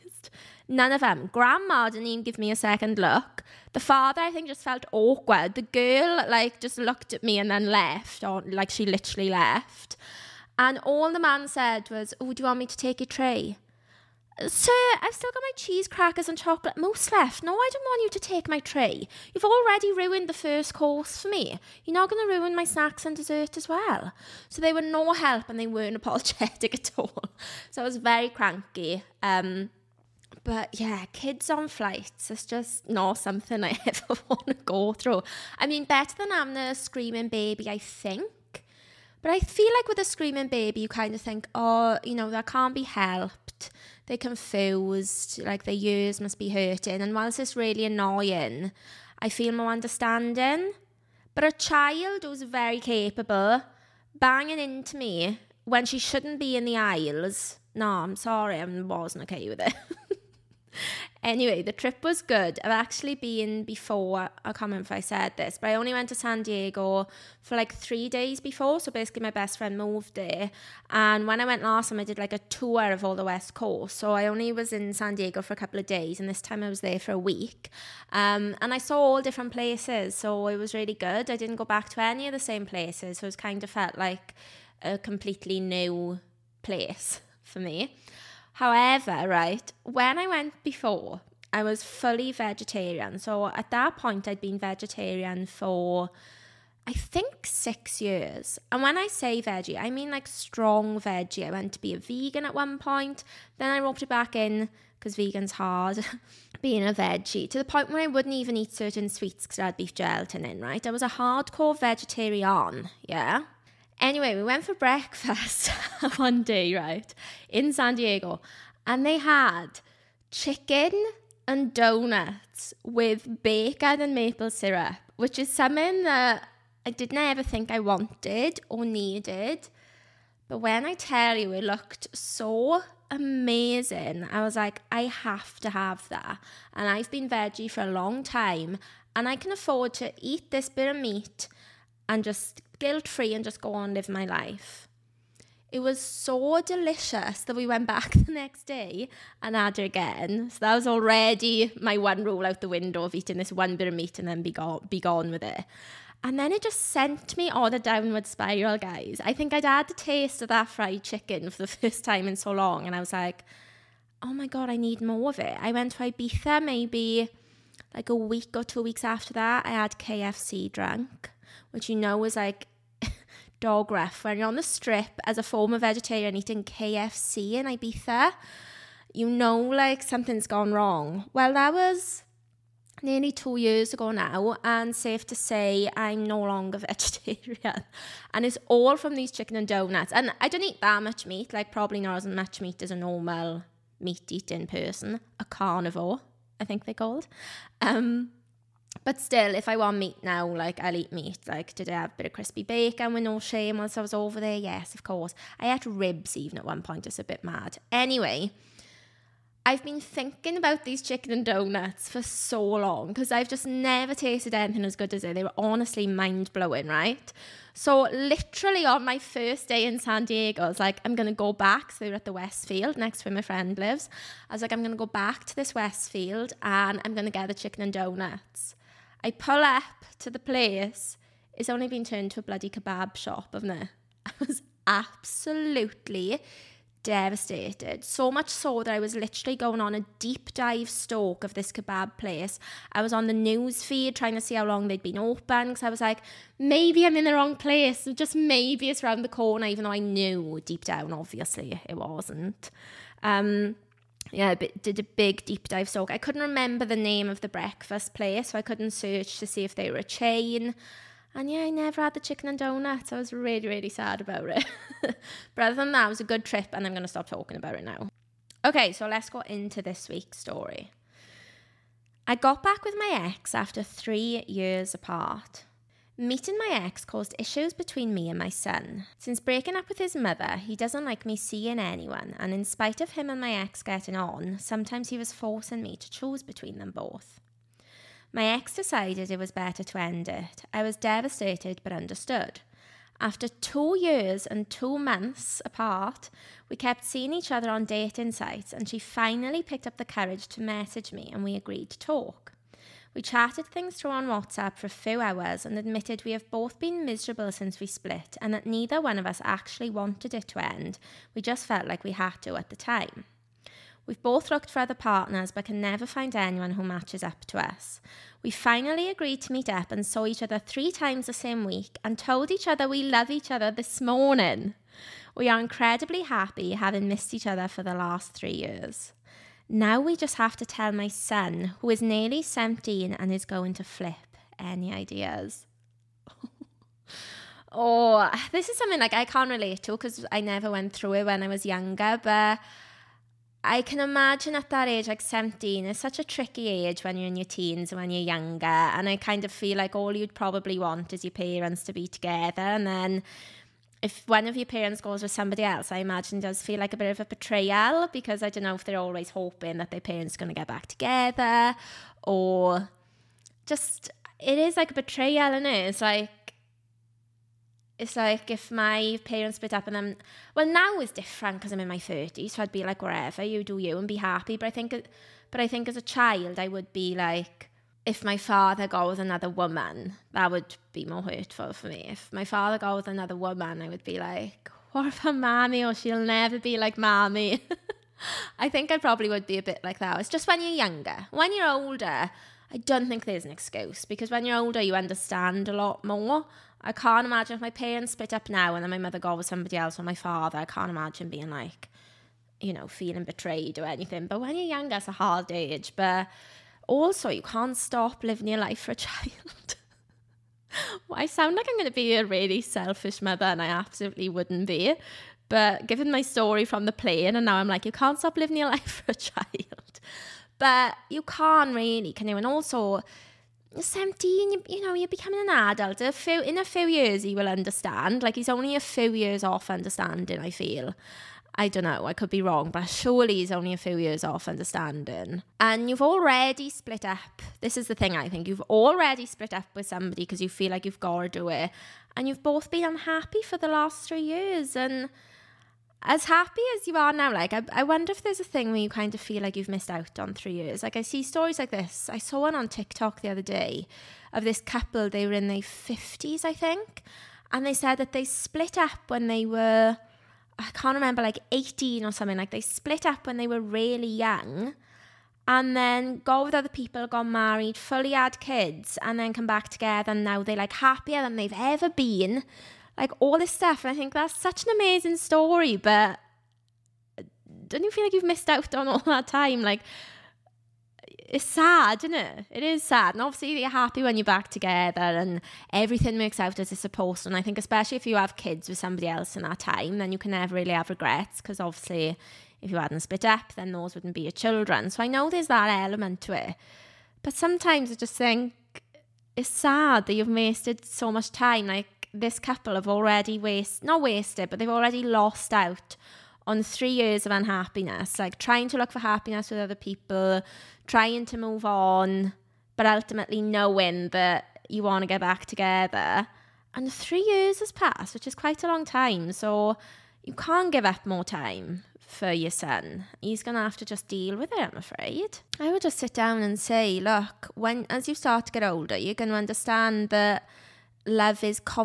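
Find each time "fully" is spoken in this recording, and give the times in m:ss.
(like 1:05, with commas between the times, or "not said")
1:31, 7:47.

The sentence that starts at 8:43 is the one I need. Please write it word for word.
He's going to have to just deal with it, I'm afraid.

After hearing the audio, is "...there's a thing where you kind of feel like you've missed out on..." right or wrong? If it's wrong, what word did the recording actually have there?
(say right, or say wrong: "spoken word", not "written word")
right.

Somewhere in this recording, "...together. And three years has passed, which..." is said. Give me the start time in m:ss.
8:35.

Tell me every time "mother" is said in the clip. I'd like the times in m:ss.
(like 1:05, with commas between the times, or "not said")
4:40, 6:38, 6:53.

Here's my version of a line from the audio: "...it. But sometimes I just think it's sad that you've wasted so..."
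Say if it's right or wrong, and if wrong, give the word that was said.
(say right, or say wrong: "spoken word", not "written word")
right.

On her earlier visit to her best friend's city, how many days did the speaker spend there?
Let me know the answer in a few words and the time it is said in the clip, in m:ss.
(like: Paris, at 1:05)
3, at 1:07.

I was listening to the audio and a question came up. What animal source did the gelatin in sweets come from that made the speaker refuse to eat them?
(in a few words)
Beef.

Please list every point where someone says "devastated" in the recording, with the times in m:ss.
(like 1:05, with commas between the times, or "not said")
3:57, 4:50.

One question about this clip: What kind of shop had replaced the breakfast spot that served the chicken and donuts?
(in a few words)
Kebab shop.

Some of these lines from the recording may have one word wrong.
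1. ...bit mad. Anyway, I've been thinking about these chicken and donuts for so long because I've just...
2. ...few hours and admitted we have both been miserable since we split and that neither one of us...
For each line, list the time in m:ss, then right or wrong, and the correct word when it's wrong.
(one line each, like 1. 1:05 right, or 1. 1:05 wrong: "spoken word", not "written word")
1. 3:27 right
2. 5:04 right.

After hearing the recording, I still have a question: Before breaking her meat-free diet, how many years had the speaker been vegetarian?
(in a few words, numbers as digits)
6.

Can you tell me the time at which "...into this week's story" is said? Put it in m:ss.
4:29.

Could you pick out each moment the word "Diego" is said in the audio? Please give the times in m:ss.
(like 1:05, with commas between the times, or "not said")
1:06, 1:15, 1:57, 3:40.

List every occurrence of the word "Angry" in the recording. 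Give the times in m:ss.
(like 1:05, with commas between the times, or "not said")
not said.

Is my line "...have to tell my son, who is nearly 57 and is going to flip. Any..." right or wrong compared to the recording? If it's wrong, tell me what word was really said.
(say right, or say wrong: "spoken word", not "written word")
wrong: "17", not "57".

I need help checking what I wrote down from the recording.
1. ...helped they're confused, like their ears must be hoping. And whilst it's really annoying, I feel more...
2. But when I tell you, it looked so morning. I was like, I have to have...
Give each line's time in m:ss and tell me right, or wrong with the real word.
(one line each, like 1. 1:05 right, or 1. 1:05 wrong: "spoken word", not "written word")
1. 0:42 wrong: "hurting", not "hoping"
2. 2:10 wrong: "amazing", not "morning".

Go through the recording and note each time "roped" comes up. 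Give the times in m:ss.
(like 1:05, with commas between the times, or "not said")
1:43.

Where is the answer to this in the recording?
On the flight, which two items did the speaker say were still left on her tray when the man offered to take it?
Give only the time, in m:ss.
0:15.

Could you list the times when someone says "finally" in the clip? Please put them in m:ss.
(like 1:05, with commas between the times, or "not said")
4:58, 5:18.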